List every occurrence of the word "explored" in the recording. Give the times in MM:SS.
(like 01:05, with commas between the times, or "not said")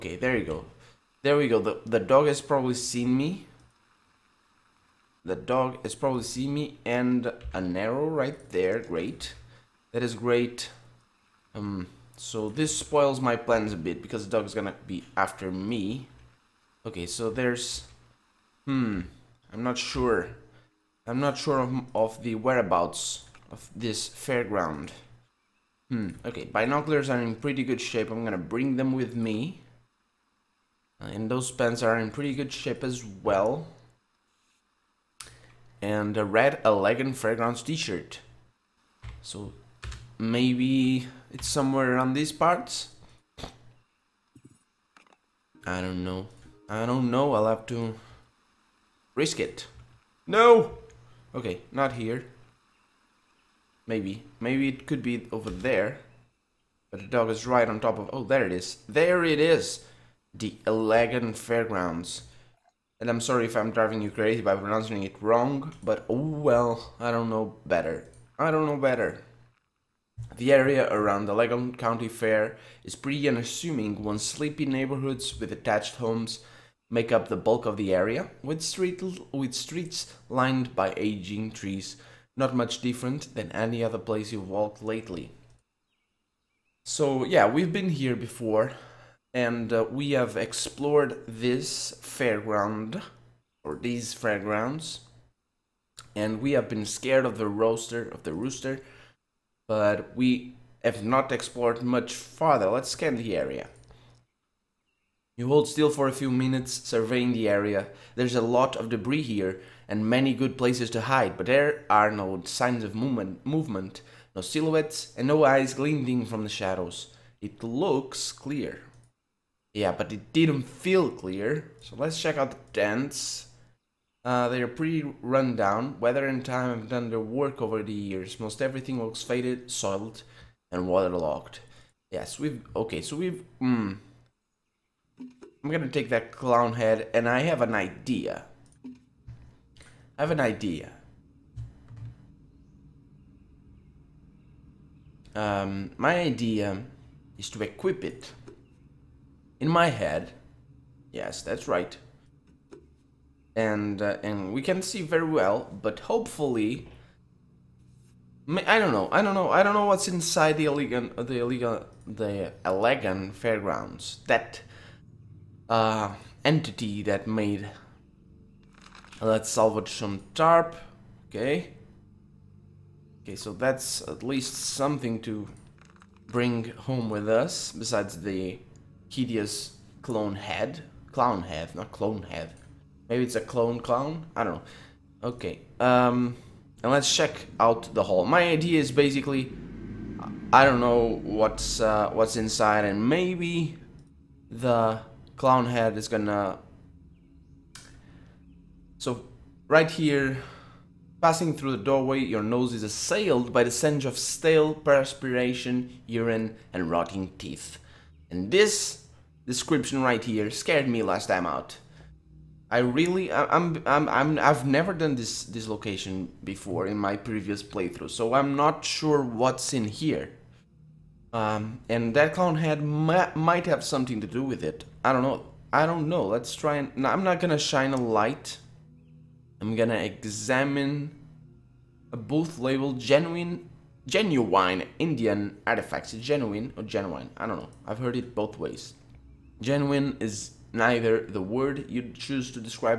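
01:30, 01:41.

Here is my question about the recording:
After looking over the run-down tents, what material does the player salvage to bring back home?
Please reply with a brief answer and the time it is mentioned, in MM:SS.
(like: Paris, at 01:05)
tarp, at 02:50.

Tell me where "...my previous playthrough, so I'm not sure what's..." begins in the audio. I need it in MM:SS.
03:36.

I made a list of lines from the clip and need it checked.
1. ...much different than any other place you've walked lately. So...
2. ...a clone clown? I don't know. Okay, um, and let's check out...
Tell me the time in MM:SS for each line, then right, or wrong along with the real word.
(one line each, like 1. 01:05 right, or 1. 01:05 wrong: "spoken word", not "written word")
1. 01:22 right
2. 03:03 right.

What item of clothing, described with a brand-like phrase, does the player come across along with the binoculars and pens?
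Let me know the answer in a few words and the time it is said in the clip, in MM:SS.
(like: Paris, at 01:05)
red elegant fragrance t-shirt, at 00:36.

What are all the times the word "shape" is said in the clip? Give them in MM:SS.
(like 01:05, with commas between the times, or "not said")
00:27, 00:32.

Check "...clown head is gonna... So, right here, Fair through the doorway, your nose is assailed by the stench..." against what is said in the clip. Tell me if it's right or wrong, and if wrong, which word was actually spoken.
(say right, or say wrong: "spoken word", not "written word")
wrong: "Passing", not "Fair".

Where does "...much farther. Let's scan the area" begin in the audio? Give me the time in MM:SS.
01:41.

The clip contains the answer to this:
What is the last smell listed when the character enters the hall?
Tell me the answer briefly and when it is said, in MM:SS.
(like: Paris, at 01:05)
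rotting teeth, at 03:26.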